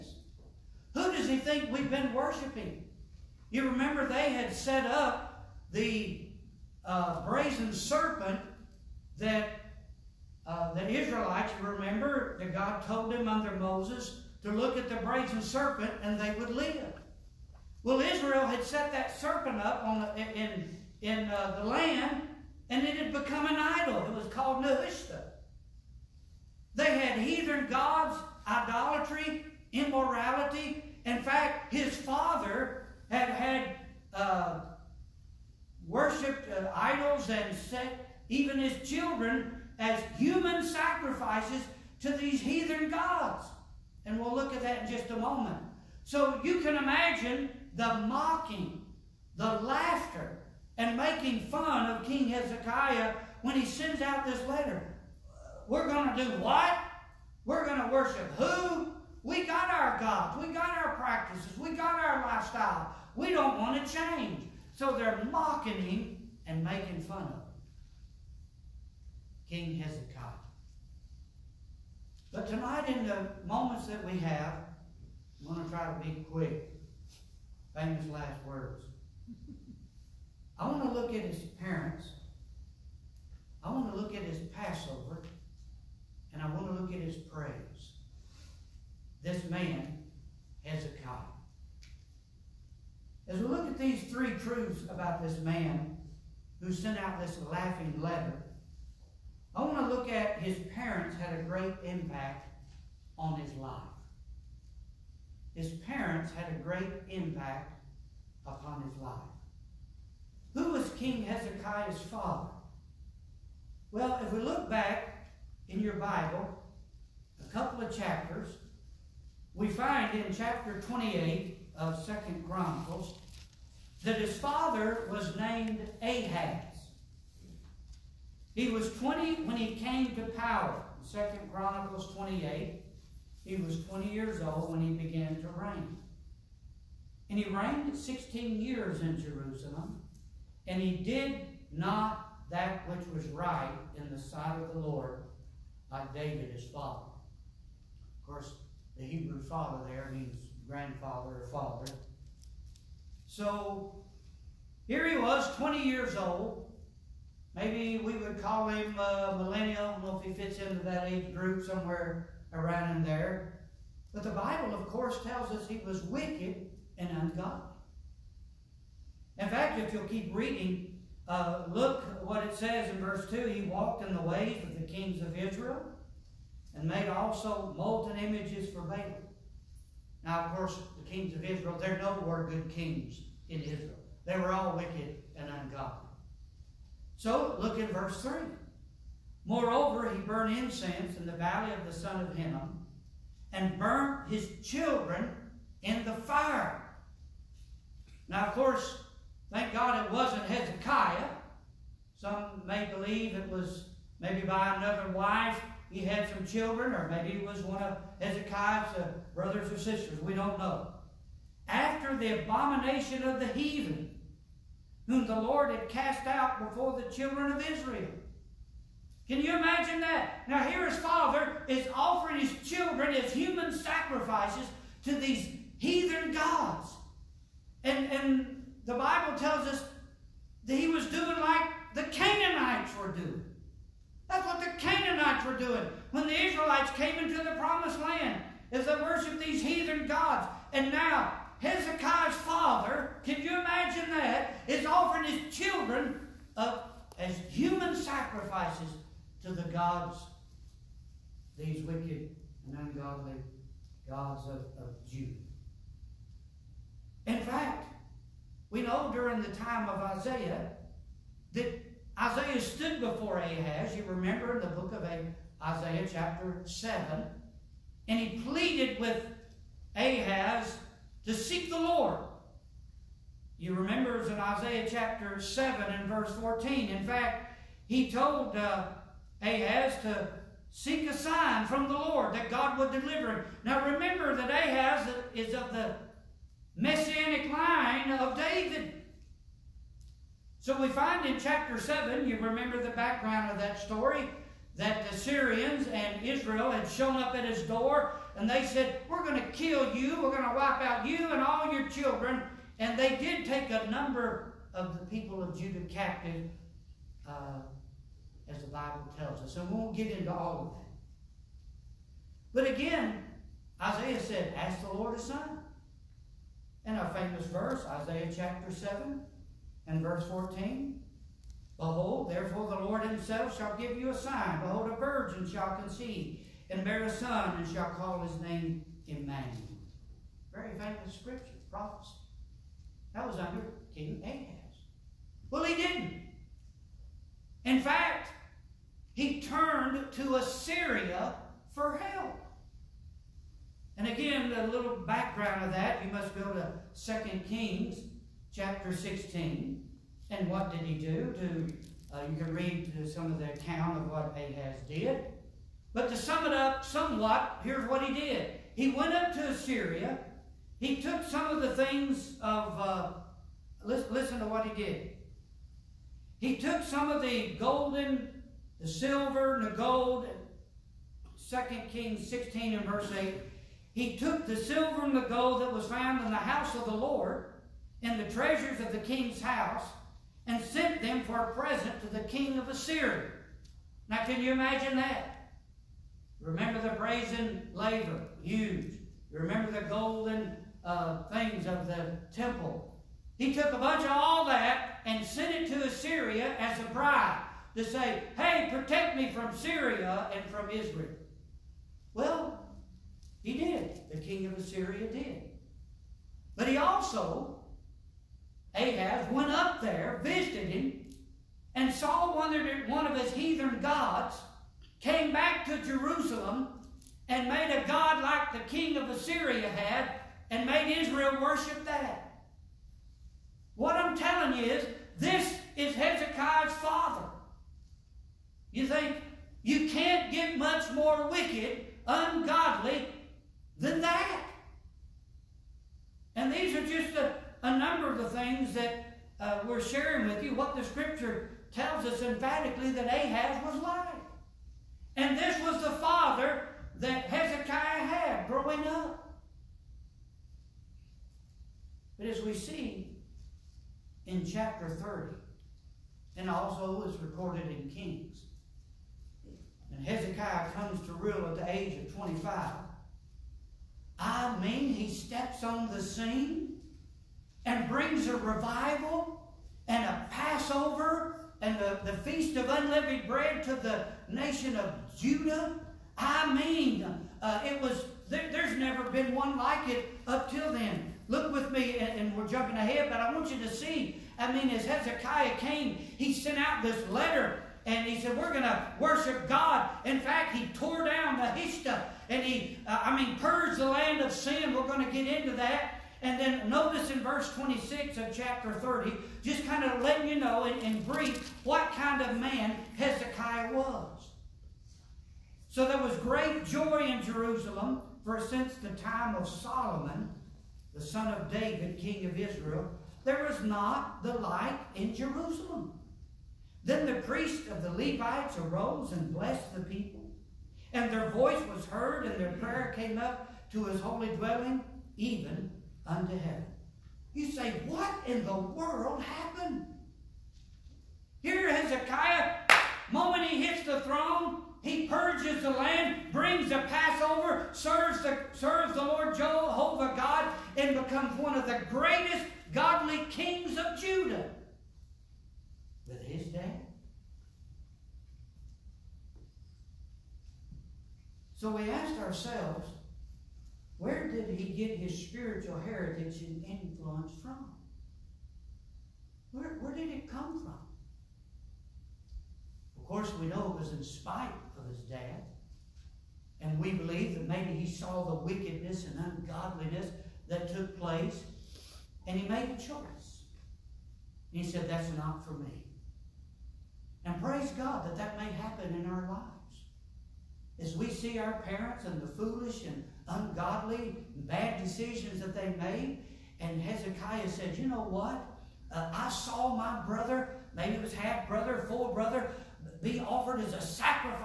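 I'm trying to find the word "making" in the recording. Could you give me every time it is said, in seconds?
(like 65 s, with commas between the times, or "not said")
50 s, 66 s.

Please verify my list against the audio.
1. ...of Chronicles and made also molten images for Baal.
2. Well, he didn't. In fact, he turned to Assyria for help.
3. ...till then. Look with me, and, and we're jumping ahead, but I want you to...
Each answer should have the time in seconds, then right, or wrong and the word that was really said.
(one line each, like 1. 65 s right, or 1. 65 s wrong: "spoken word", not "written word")
1. 175 s wrong: "Israel", not "Chronicles"
2. 335 s right
3. 480 s right.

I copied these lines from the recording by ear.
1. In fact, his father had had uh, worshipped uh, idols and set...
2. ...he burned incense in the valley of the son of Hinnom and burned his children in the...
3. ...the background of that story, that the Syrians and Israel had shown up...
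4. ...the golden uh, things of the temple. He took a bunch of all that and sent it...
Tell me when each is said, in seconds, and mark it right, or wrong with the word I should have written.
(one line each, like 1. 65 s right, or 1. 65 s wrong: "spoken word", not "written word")
1. 31 s right
2. 190 s right
3. 292 s right
4. 389 s right.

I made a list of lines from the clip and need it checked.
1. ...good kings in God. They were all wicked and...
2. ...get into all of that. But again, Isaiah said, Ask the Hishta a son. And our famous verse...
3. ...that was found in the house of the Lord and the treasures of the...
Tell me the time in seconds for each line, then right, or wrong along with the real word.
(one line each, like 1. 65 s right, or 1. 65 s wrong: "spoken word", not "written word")
1. 182 s wrong: "Israel", not "God"
2. 309 s wrong: "Lord", not "Hishta"
3. 375 s right.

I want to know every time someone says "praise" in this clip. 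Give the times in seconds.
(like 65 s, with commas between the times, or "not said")
87 s, 577 s.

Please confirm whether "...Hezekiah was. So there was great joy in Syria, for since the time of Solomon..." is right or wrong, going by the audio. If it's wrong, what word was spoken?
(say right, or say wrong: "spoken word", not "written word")
wrong: "Jerusalem", not "Syria".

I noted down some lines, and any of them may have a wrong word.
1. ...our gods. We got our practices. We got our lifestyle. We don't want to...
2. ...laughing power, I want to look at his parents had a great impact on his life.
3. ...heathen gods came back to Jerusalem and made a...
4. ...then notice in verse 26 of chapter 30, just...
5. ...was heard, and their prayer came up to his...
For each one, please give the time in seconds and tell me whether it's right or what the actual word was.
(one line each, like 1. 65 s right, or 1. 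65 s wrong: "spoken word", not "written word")
1. 59 s right
2. 97 s wrong: "letter", not "power"
3. 413 s right
4. 496 s right
5. 521 s right.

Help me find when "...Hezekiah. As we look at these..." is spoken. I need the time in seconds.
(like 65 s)
90 s.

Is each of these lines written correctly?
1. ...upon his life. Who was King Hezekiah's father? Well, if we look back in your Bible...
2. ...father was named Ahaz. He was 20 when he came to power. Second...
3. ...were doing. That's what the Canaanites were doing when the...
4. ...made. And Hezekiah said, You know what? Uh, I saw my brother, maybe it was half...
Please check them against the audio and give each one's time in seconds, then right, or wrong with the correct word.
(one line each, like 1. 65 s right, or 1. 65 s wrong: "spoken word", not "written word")
1. 108 s right
2. 124 s right
3. 232 s right
4. 585 s right.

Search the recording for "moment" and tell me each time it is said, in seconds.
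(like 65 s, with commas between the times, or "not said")
45 s, 73 s, 533 s.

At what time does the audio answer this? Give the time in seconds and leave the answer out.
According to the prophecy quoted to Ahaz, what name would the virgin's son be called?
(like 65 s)
329 s.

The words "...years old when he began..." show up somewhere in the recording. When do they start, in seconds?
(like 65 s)
134 s.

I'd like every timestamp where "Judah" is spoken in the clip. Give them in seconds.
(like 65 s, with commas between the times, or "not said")
255 s, 305 s, 475 s, 543 s.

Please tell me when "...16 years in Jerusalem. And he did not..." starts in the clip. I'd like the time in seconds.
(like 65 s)
137 s.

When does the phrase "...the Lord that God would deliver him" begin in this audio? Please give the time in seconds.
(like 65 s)
281 s.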